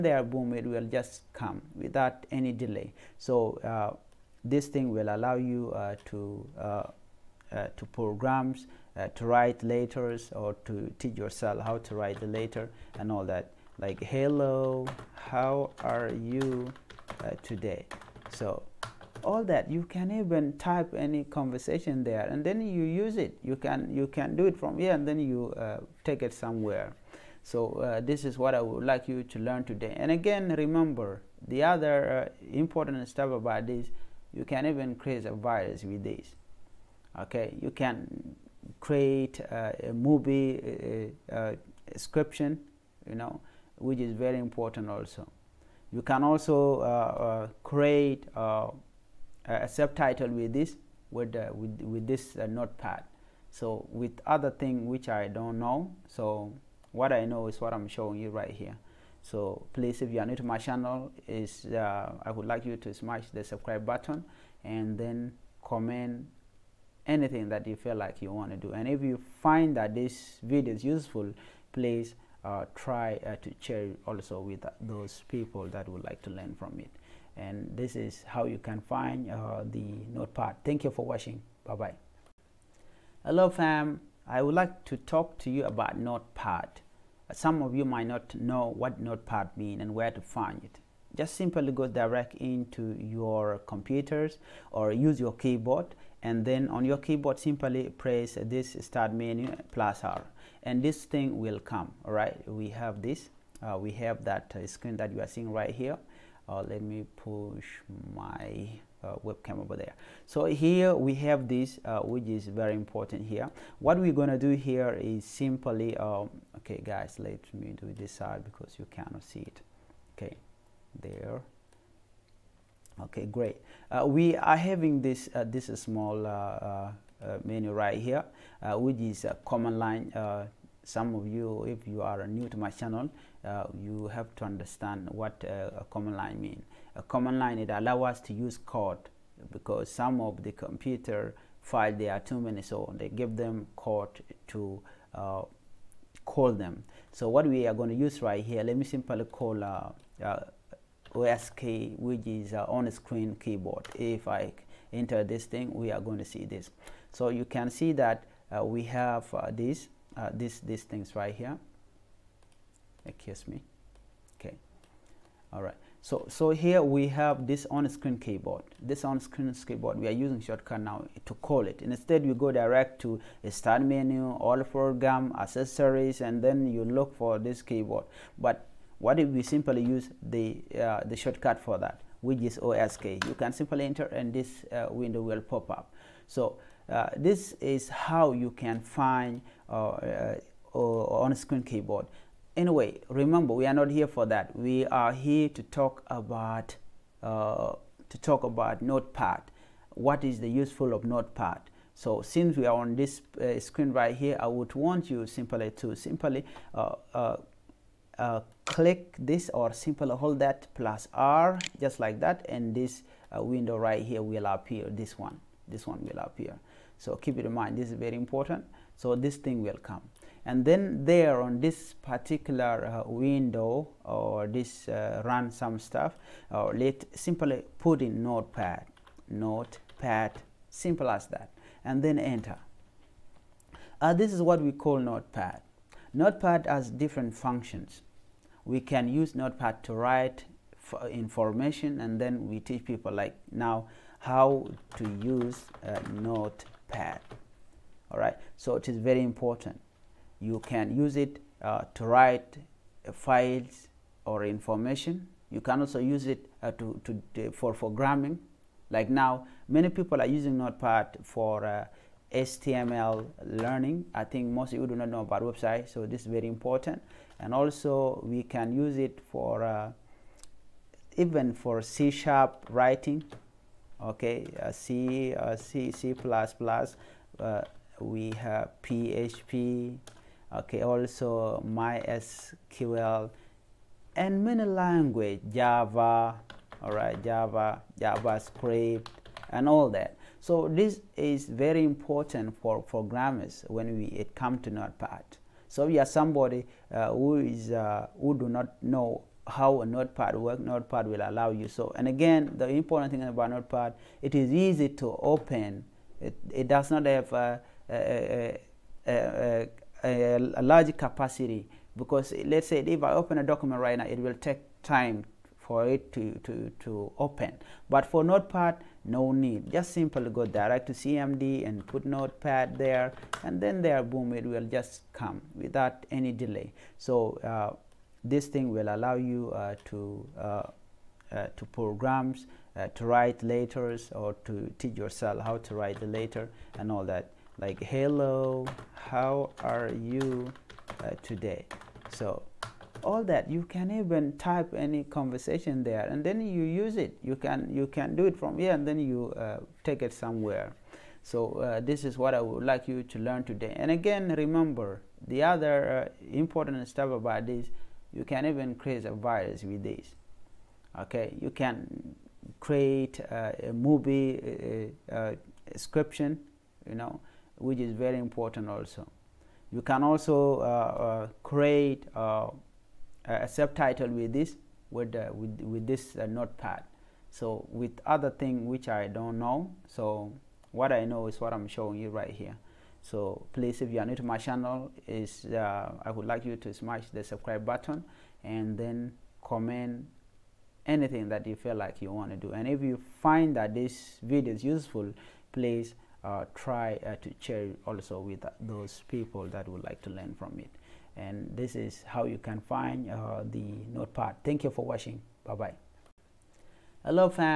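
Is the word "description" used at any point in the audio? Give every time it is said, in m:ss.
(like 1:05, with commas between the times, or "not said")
0:41, 6:05.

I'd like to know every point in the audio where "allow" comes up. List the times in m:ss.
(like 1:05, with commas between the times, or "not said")
0:05, 2:17, 5:01, 5:28.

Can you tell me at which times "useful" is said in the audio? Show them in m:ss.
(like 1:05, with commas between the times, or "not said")
1:10, 3:20, 6:34.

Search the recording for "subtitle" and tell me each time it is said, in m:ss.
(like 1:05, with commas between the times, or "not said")
0:49, 6:13.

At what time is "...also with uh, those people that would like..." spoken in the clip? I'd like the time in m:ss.
1:14.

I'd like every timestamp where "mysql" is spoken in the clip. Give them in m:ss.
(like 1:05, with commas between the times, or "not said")
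4:41.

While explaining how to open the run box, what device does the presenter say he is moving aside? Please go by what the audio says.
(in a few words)
webcam.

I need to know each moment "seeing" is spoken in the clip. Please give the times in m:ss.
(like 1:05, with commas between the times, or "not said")
1:45.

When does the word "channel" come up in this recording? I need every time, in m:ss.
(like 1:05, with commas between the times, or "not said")
1:00, 2:12, 6:24.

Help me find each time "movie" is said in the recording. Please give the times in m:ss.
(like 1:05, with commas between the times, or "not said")
0:39, 6:03.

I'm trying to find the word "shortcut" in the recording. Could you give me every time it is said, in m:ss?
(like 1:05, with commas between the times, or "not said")
2:50, 3:01.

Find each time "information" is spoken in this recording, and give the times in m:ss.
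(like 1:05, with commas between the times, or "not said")
4:01, 4:14.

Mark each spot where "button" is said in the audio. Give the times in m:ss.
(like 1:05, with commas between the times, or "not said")
1:03, 6:27.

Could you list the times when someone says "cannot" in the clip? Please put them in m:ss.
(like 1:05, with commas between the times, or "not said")
1:58.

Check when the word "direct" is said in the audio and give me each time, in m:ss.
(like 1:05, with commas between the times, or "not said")
1:31, 2:52, 5:20.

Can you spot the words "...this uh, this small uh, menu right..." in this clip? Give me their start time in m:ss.
2:05.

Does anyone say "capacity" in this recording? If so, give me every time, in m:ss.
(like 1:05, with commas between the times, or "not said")
5:10.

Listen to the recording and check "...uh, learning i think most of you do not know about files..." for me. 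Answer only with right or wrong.
wrong.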